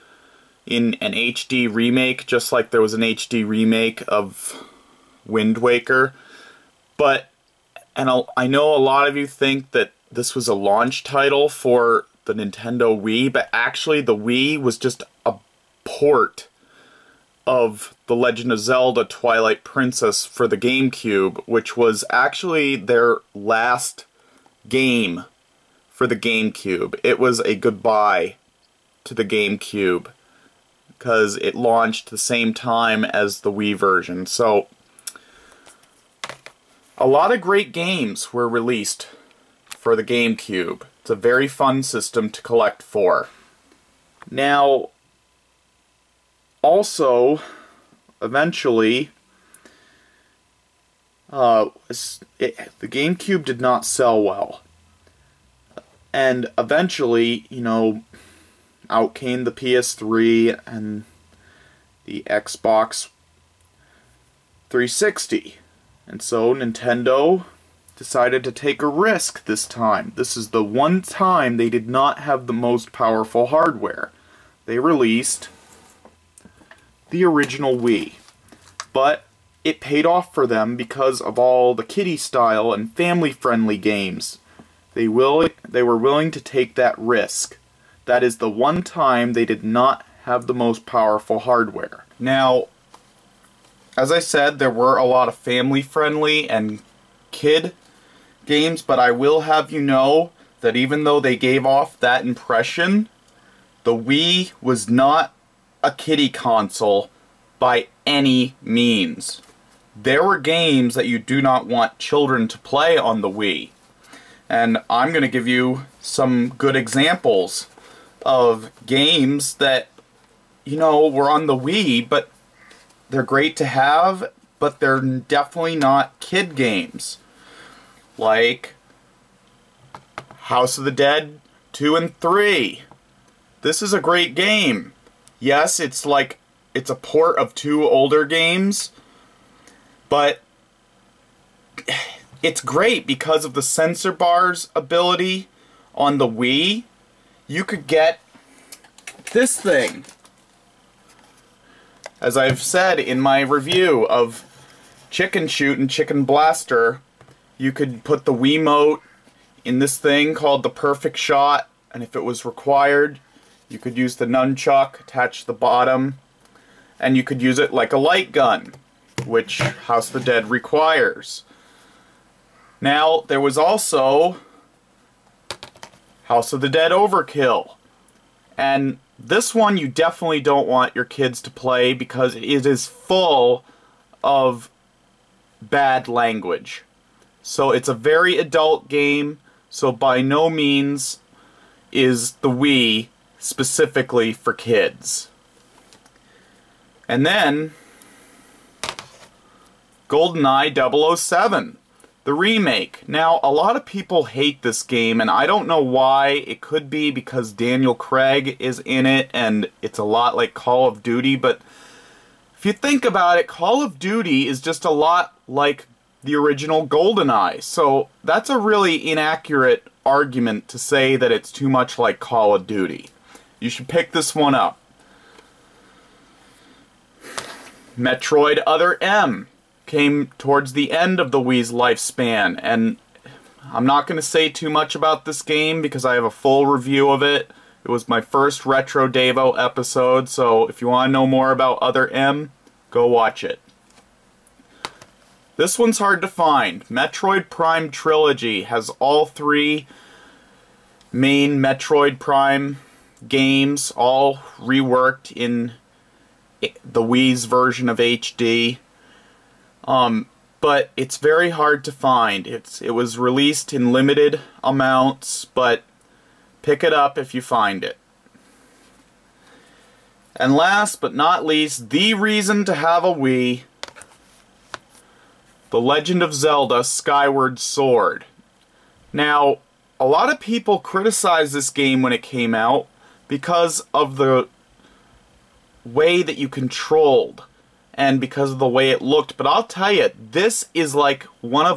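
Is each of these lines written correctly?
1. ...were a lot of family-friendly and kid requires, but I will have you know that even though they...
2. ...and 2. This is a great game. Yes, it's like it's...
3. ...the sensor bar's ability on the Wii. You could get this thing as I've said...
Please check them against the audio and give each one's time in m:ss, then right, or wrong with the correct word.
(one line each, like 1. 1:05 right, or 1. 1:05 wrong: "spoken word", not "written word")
1. 1:34 wrong: "games", not "requires"
2. 2:11 wrong: "3", not "2"
3. 2:23 right.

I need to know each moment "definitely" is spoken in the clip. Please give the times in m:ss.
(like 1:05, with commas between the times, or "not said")
2:05, 2:59.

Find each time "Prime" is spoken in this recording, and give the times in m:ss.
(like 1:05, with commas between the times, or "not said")
4:07, 4:12.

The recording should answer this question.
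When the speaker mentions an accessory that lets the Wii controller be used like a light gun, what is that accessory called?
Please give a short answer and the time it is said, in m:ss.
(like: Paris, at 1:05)
Perfect Shot, at 2:40.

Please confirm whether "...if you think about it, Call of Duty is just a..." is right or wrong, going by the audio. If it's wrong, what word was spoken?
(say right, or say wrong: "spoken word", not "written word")
right.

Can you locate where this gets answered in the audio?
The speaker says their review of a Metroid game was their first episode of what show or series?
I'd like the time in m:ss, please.
3:58.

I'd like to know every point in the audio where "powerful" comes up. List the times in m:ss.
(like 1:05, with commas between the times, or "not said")
1:12, 1:30.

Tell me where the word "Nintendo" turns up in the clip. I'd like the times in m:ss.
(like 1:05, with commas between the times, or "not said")
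0:12, 1:06.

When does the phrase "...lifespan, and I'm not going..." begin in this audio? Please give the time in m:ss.
3:51.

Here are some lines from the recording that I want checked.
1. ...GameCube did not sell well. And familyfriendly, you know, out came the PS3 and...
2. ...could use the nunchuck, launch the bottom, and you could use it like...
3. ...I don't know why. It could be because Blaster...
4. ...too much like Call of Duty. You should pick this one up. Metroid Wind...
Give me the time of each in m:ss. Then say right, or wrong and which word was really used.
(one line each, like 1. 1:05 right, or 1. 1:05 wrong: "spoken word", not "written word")
1. 0:52 wrong: "eventually", not "familyfriendly"
2. 2:43 wrong: "attach", not "launch"
3. 3:25 wrong: "Daniel", not "Blaster"
4. 3:41 wrong: "Other", not "Wind".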